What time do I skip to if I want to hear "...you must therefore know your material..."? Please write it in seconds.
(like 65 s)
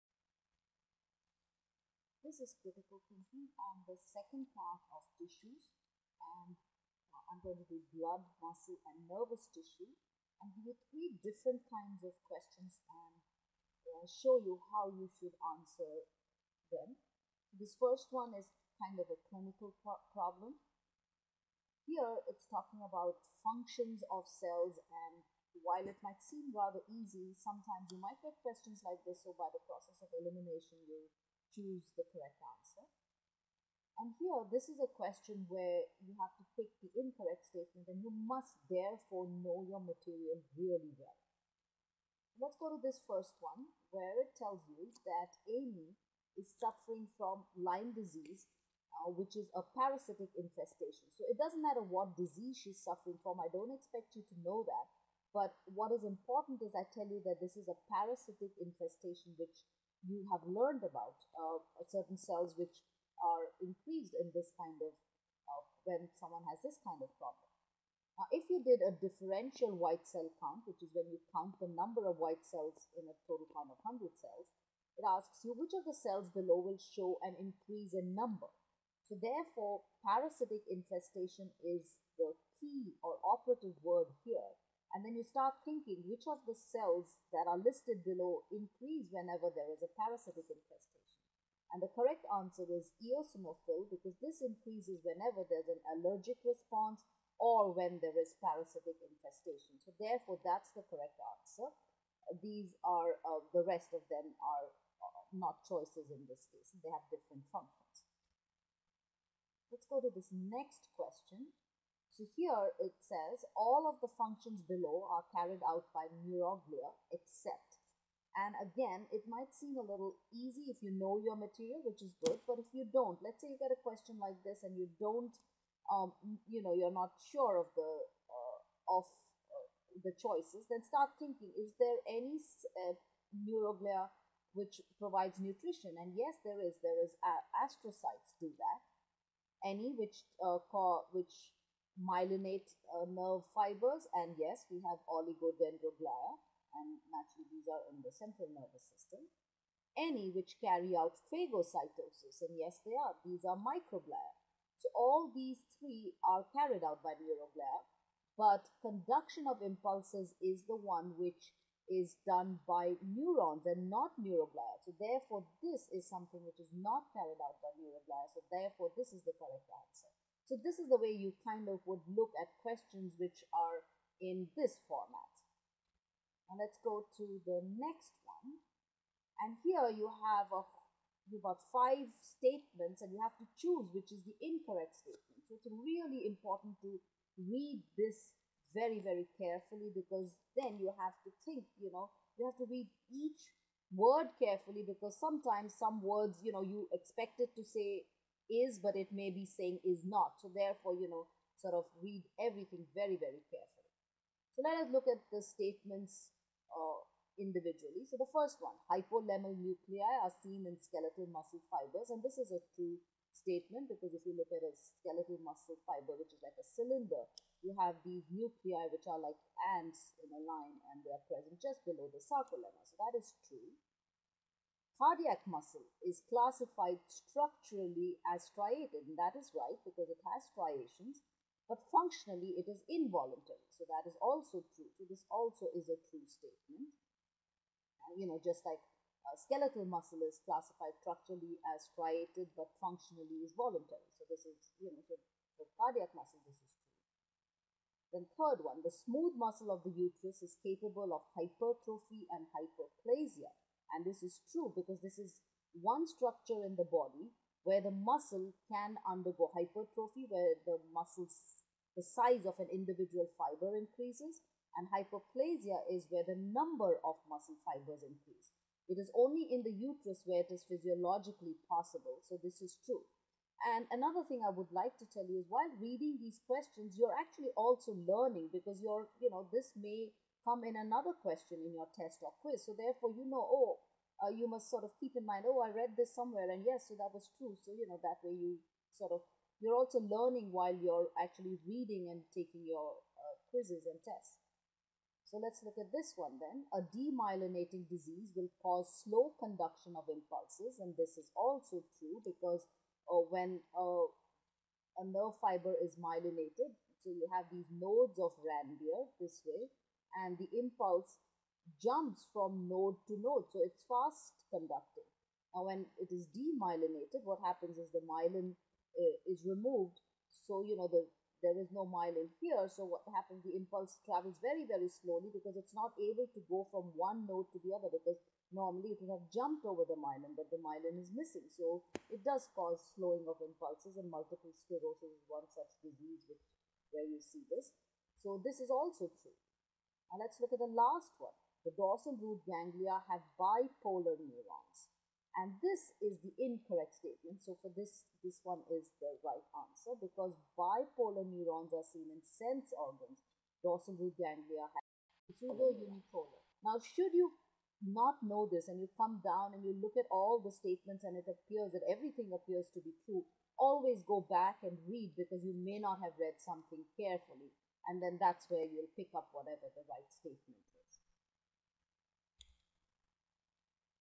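38 s.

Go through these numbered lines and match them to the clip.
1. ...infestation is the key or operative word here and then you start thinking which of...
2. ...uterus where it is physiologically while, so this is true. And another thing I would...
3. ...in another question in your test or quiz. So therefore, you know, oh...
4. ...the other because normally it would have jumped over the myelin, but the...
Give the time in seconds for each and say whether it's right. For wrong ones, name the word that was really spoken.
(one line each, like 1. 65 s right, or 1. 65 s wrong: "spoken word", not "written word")
1. 80 s right
2. 269 s wrong: "possible", not "while"
3. 280 s right
4. 327 s right.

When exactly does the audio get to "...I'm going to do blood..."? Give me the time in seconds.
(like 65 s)
7 s.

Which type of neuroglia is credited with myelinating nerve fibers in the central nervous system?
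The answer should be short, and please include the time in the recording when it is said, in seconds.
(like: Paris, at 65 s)
Oligodendroglia, at 145 s.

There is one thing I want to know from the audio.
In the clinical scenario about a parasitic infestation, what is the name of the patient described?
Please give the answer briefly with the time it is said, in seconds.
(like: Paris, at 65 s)
Amy, at 45 s.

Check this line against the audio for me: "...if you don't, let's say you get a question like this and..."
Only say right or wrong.
right.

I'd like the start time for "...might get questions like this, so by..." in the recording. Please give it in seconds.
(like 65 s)
27 s.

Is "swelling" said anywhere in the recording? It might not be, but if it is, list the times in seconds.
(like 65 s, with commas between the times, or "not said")
not said.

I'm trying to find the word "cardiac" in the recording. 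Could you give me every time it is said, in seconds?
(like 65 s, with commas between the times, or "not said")
225 s, 245 s.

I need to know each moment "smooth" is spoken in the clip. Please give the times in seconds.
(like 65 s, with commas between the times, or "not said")
248 s.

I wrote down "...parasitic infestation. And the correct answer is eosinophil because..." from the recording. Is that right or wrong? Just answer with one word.
right.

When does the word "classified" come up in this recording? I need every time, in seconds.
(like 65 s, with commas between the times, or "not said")
226 s, 240 s.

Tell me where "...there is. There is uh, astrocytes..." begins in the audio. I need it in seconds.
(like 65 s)
136 s.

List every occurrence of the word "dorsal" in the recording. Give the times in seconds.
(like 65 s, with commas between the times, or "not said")
341 s, 353 s.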